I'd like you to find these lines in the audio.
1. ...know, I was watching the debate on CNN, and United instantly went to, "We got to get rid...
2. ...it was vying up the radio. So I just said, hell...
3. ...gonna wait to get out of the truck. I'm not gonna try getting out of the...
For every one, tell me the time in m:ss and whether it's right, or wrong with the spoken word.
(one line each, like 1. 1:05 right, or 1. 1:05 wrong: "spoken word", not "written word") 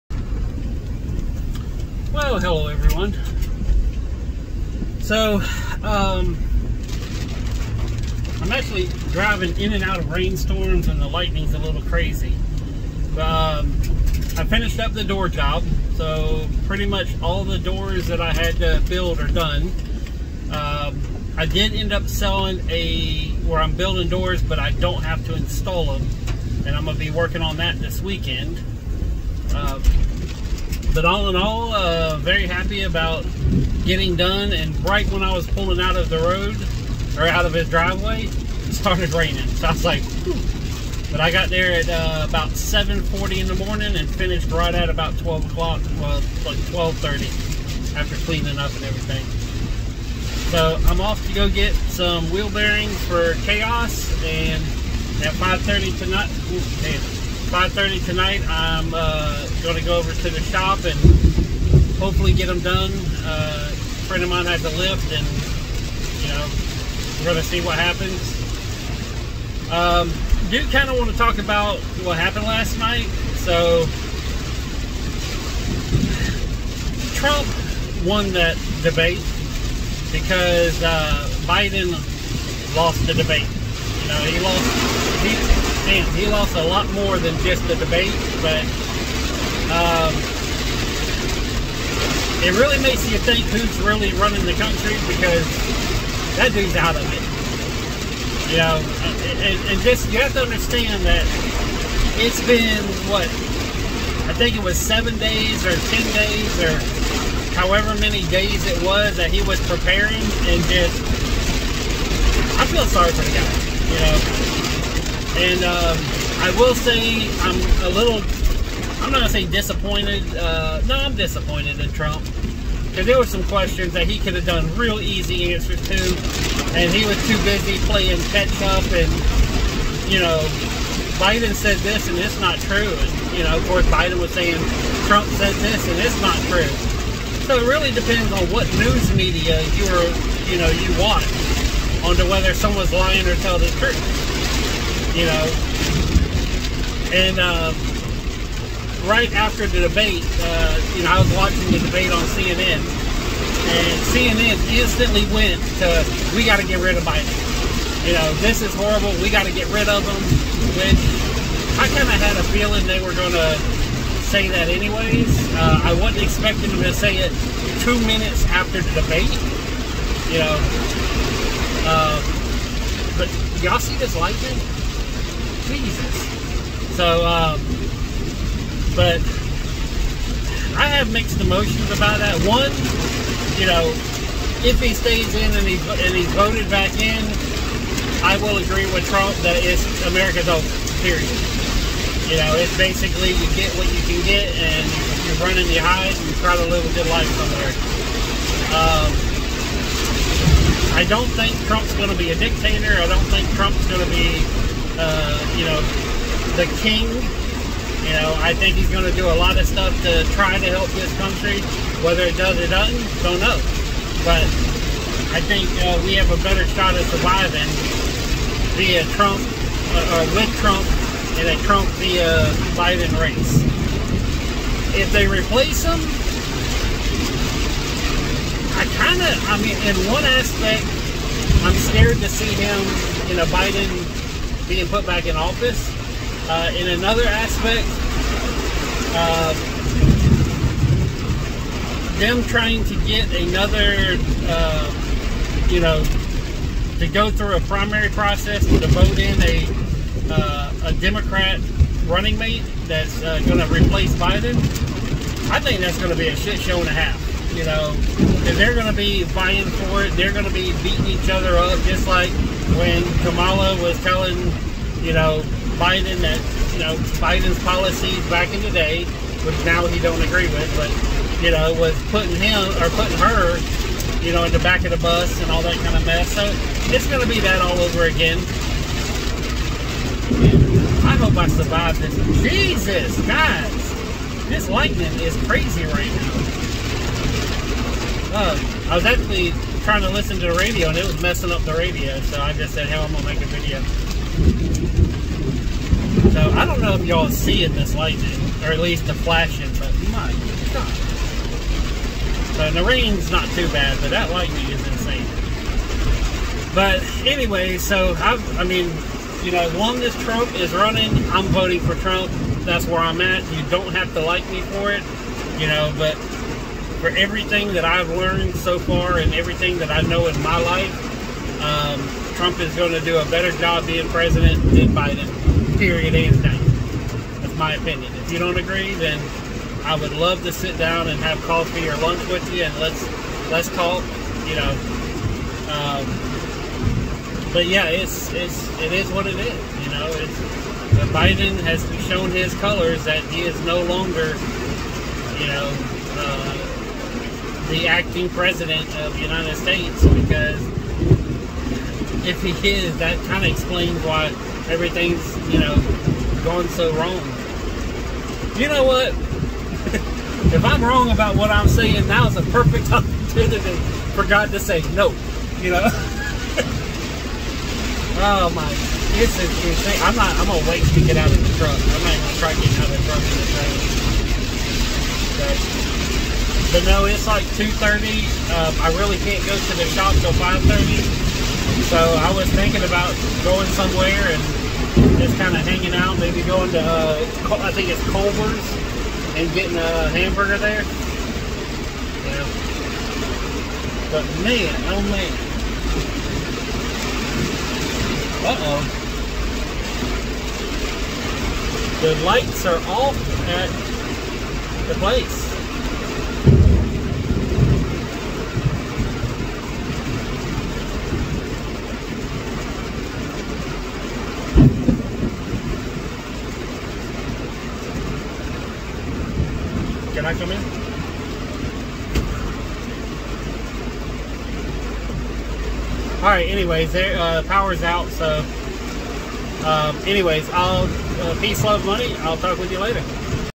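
1. 2:31 wrong: "CNN", not "United"
2. 4:50 wrong: "messing", not "vying"
3. 6:10 right.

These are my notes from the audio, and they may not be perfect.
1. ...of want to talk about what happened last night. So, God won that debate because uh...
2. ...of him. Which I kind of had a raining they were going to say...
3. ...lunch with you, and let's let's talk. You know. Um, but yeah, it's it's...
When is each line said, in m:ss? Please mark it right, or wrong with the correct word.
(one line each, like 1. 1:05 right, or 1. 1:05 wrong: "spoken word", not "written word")
1. 1:10 wrong: "Trump", not "God"
2. 2:39 wrong: "feeling", not "raining"
3. 5:31 right.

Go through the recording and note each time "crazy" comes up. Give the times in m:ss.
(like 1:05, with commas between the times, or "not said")
0:11, 4:45.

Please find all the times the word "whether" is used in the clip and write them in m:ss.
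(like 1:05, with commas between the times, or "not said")
2:22, 3:32.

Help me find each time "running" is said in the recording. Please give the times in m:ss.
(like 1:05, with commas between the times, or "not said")
1:34, 3:15, 4:12, 5:10.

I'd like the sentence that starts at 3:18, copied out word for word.
Um, I don't think Trump's going to be a dictator.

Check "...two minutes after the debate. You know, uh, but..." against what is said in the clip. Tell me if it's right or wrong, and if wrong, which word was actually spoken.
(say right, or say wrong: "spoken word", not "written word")
right.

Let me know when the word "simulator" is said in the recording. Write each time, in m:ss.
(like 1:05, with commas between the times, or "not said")
not said.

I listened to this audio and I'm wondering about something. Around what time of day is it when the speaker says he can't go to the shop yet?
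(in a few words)
2:30.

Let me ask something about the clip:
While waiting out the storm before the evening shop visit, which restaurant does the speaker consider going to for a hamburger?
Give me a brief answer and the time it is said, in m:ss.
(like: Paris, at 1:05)
Culver's, at 6:28.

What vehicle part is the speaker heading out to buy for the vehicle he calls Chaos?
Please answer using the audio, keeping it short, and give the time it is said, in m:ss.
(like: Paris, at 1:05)
Wheel bearings, at 0:52.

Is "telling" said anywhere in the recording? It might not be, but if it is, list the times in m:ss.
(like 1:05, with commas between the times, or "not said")
2:23, 4:24.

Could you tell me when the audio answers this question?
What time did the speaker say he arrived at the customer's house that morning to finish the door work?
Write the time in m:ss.
0:42.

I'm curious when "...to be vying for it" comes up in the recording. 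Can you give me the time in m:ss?
4:18.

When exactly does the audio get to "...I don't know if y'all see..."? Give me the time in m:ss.
4:56.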